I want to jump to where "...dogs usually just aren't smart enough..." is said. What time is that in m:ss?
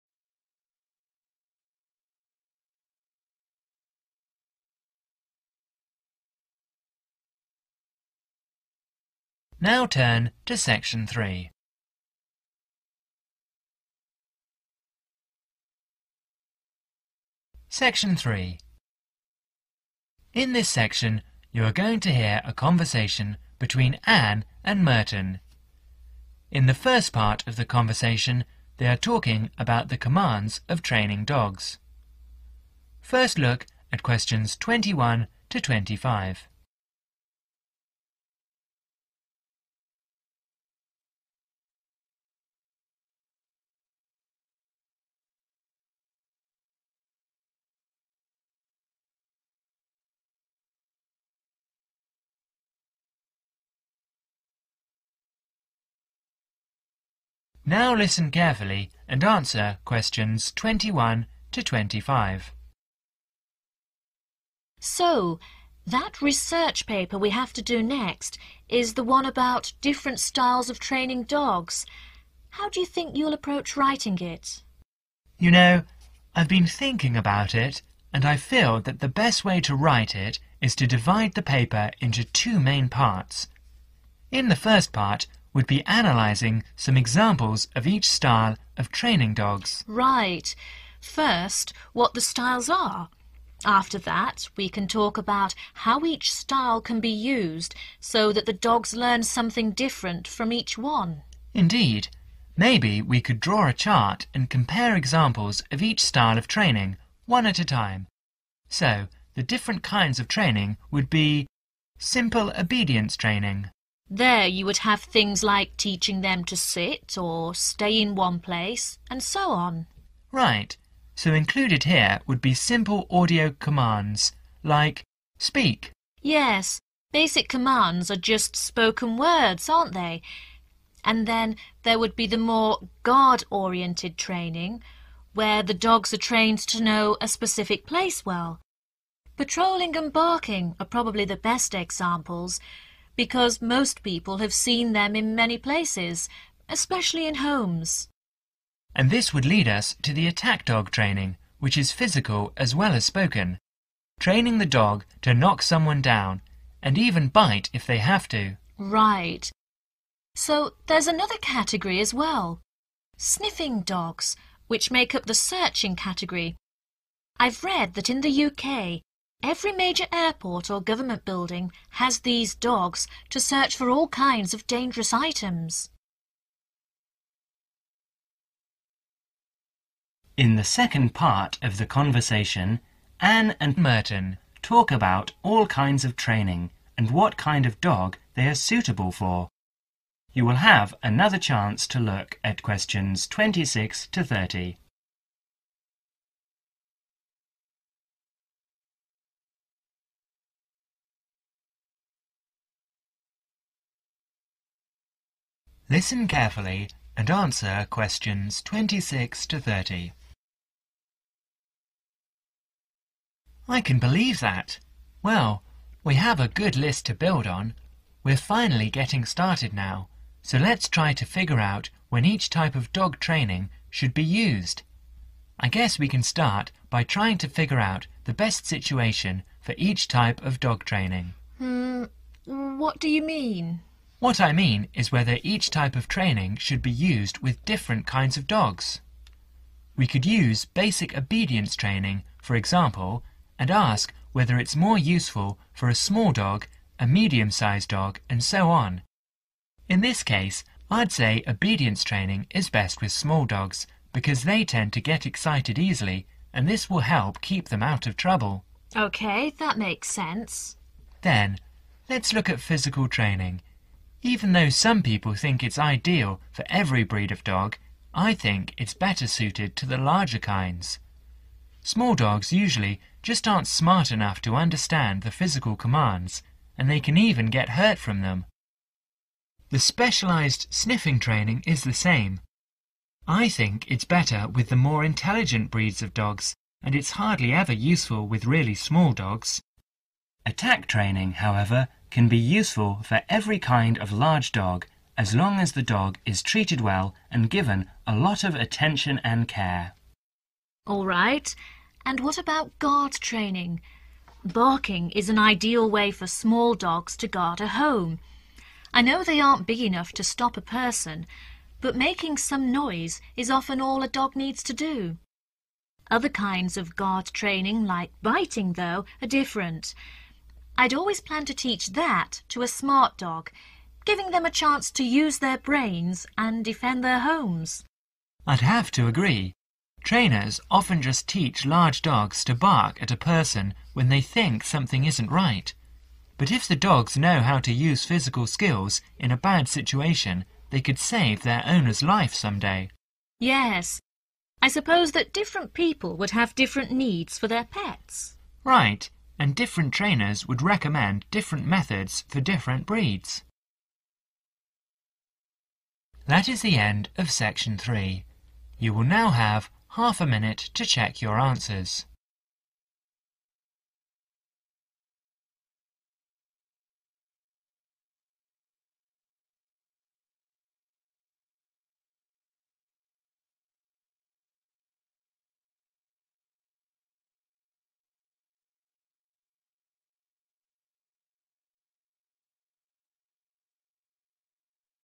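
4:32.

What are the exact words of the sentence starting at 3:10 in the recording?
You will have another chance to look at questions 26 to 30.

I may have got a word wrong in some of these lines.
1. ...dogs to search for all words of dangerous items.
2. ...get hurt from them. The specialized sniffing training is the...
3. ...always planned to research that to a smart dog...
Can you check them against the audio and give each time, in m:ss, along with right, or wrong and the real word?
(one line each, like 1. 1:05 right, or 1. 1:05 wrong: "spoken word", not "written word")
1. 2:52 wrong: "kinds", not "words"
2. 4:37 right
3. 5:20 wrong: "teach", not "research".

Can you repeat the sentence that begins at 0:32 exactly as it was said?
First look at questions 21 to 25.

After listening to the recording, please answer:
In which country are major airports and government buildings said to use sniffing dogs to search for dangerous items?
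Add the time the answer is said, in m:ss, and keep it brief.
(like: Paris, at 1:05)
UK, at 2:48.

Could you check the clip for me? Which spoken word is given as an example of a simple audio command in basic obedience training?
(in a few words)
speak.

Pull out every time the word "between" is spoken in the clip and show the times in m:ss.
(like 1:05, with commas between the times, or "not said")
0:23.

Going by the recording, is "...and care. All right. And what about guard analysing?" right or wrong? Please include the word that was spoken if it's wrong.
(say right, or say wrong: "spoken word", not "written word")
wrong: "training", not "analysing".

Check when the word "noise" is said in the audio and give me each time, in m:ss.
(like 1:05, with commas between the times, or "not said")
5:12.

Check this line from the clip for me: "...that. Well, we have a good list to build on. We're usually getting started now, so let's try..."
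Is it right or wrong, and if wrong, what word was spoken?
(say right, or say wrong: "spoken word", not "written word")
wrong: "finally", not "usually".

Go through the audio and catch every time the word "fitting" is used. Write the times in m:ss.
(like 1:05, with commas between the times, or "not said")
not said.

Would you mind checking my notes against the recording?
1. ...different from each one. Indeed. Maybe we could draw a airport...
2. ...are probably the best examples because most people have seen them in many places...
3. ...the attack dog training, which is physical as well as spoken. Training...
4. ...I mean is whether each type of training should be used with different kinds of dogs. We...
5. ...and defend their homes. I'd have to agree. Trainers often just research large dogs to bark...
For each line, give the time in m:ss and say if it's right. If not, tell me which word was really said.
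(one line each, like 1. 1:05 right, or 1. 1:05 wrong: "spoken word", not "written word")
1. 1:39 wrong: "chart", not "airport"
2. 2:20 right
3. 2:30 right
4. 3:54 right
5. 5:26 wrong: "teach", not "research".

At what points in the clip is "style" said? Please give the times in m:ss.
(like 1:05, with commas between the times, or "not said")
1:10, 1:28, 1:32, 1:36, 1:46.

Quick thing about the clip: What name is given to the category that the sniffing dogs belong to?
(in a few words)
searching.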